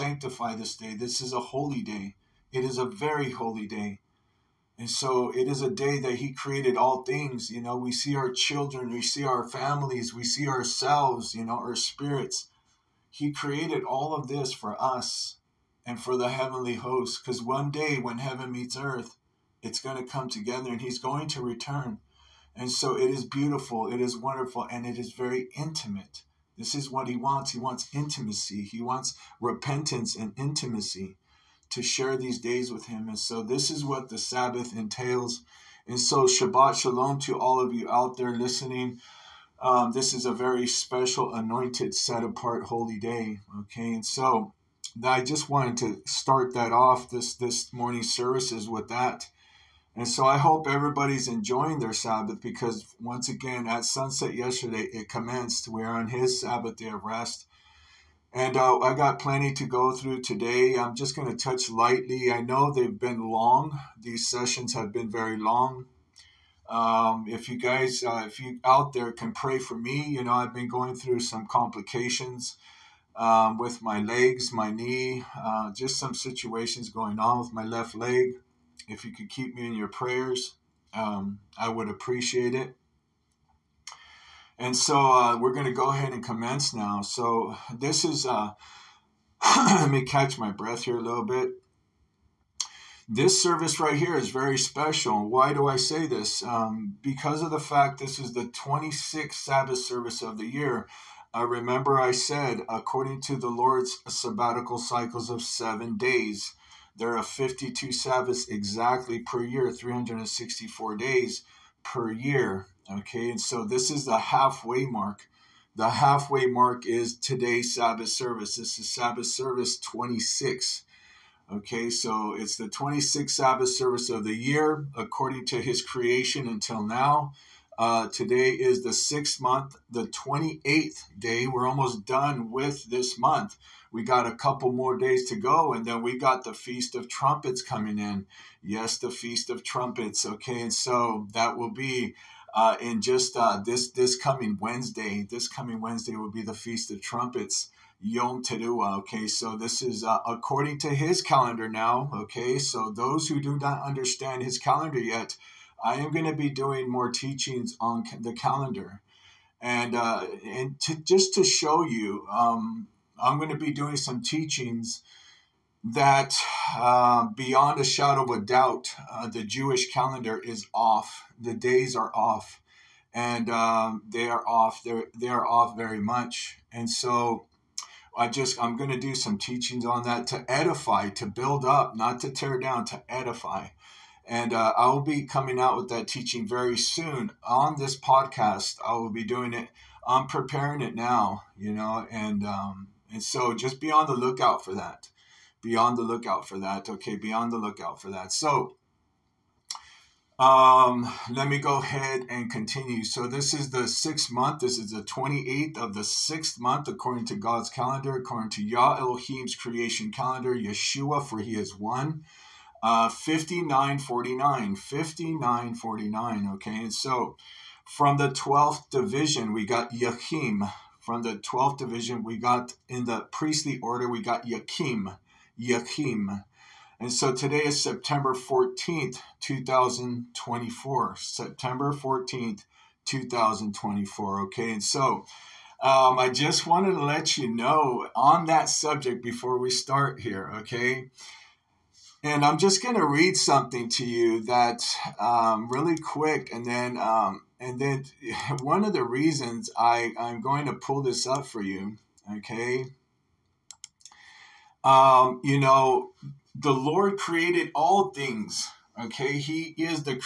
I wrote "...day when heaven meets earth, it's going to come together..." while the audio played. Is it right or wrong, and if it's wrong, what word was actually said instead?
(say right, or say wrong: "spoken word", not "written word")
right.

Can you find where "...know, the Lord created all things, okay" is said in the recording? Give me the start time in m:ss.
4:15.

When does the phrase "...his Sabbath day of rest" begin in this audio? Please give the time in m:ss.
0:56.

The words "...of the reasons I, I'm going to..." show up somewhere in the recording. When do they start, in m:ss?
4:08.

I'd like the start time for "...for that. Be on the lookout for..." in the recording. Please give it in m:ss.
3:14.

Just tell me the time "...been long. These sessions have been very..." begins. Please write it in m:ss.
1:02.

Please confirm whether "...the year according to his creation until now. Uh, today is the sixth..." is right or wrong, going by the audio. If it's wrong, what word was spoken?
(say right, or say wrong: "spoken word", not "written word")
right.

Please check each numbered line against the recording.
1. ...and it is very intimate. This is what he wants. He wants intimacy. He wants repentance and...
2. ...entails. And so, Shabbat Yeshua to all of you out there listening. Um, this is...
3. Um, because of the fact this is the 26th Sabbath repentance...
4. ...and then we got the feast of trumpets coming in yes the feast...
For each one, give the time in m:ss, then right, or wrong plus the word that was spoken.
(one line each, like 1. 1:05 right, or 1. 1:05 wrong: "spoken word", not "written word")
1. 0:24 right
2. 0:34 wrong: "Shalom", not "Yeshua"
3. 1:36 wrong: "service", not "repentance"
4. 2:15 right.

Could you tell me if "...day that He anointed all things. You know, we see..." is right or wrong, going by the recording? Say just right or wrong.
wrong.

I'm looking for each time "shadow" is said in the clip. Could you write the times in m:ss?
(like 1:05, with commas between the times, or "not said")
2:47.